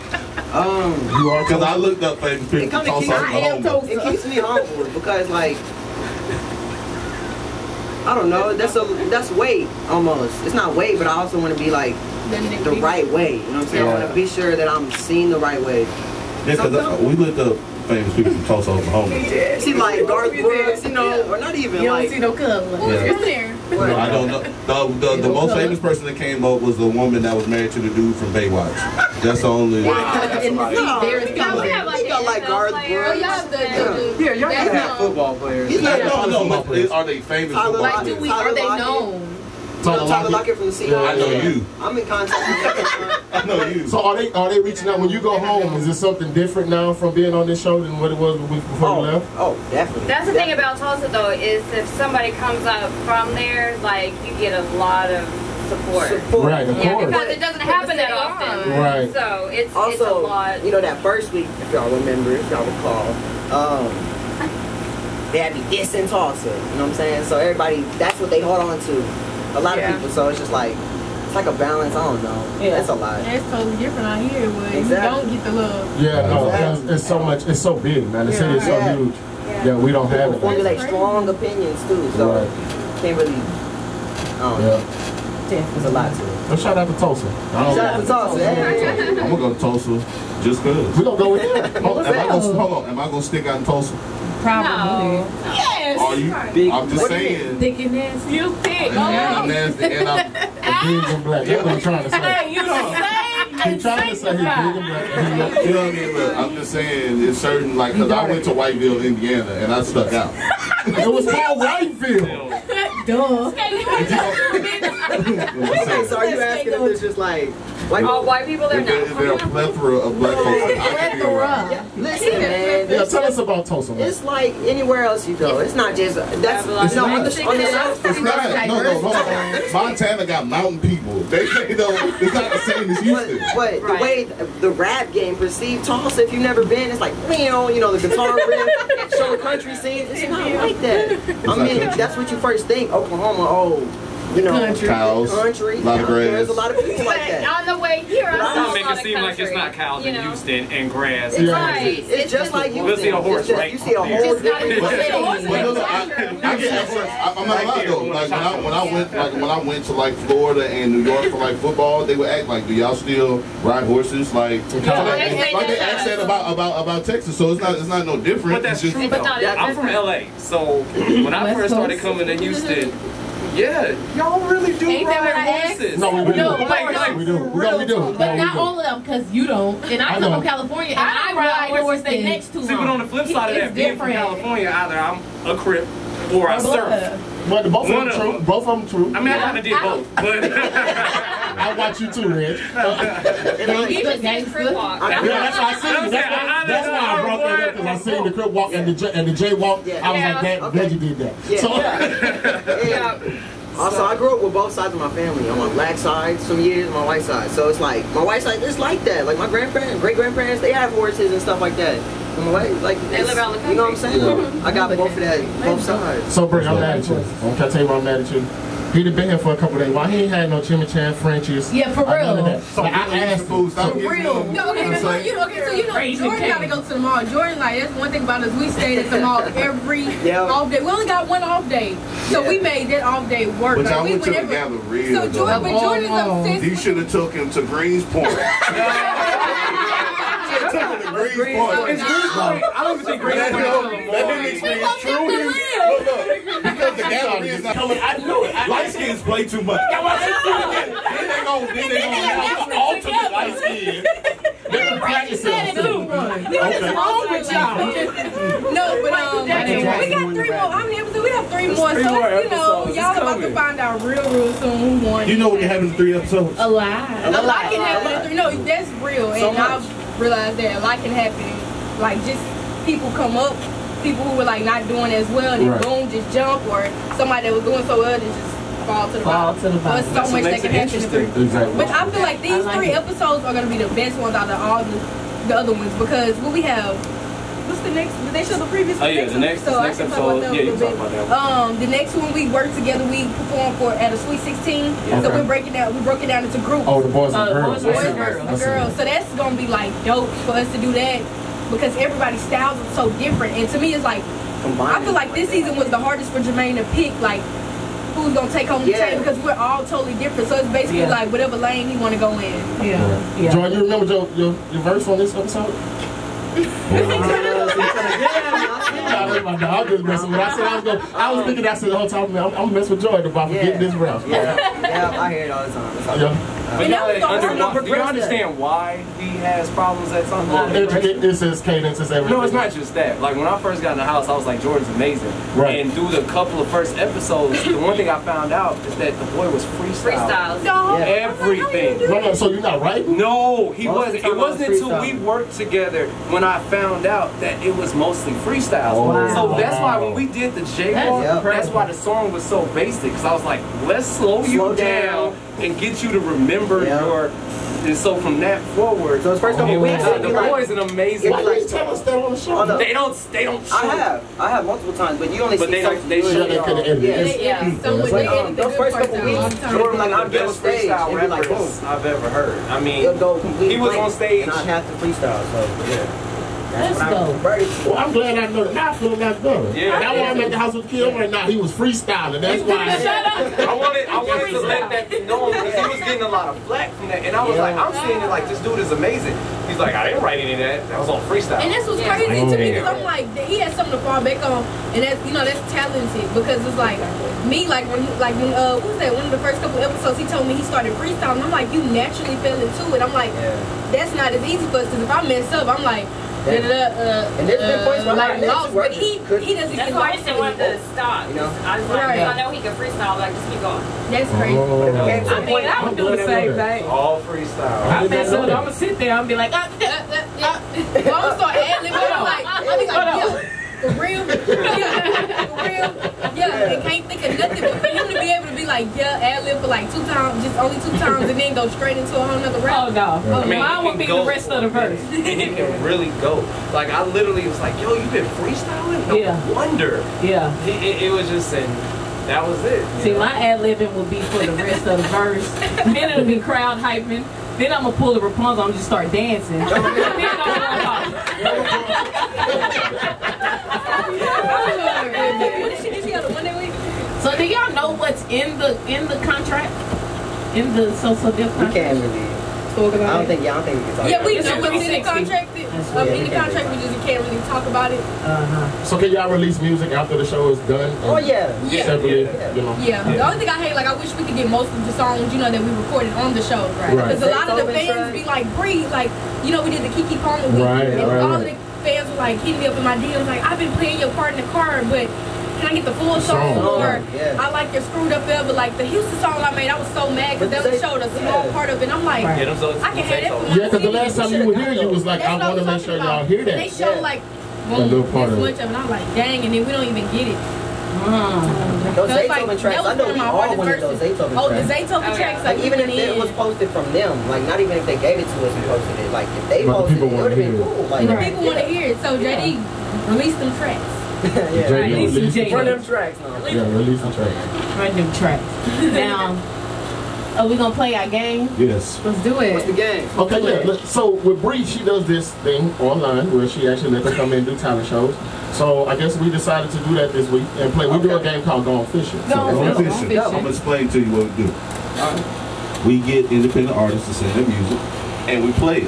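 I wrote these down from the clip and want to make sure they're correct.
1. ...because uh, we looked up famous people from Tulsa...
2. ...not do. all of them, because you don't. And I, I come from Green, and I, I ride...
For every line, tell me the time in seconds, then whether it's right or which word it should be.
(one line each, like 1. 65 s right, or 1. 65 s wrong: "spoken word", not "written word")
1. 16 s right
2. 178 s wrong: "California", not "Green".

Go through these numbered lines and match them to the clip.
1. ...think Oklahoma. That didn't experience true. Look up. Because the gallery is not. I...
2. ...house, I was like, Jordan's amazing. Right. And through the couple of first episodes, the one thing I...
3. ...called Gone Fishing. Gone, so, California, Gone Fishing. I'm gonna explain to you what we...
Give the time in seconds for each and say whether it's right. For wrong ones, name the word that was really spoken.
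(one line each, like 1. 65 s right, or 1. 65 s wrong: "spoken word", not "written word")
1. 243 s wrong: "Greenspoint", not "Oklahoma"
2. 334 s right
3. 531 s wrong: "Gone", not "California".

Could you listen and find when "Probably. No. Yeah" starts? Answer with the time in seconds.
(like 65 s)
94 s.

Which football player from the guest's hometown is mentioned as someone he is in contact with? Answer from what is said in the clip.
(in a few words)
Tyler Lockett.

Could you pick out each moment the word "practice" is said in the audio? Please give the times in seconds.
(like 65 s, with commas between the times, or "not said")
254 s.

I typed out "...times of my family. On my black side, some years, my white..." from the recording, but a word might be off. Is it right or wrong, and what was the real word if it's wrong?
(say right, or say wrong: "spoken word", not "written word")
wrong: "sides", not "times".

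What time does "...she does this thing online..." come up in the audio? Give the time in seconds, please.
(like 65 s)
524 s.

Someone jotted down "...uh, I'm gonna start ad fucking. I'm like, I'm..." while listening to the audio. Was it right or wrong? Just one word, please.
wrong.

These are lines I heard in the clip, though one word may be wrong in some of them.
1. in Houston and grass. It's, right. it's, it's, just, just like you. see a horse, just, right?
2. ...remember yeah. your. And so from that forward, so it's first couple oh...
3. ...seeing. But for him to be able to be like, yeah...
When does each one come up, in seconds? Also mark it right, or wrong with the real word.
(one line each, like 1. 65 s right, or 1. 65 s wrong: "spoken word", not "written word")
1. 150 s right
2. 356 s right
3. 427 s wrong: "nothing", not "seeing".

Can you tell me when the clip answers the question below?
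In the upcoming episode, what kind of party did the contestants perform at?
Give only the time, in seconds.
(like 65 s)
294 s.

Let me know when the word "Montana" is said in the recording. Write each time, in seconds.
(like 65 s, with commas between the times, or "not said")
129 s.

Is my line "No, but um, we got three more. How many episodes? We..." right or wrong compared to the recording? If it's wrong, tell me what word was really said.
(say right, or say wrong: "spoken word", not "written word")
right.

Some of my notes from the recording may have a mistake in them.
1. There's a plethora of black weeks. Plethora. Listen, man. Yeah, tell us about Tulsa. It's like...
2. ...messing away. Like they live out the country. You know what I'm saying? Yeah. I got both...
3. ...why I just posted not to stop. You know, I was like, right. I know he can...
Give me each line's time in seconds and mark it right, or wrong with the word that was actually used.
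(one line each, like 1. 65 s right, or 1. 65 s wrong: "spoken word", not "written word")
1. 119 s wrong: "folks", not "weeks"
2. 212 s wrong: "fucking", not "messing"
3. 409 s wrong: "wanted", not "posted".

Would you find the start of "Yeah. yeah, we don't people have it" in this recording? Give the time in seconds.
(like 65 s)
79 s.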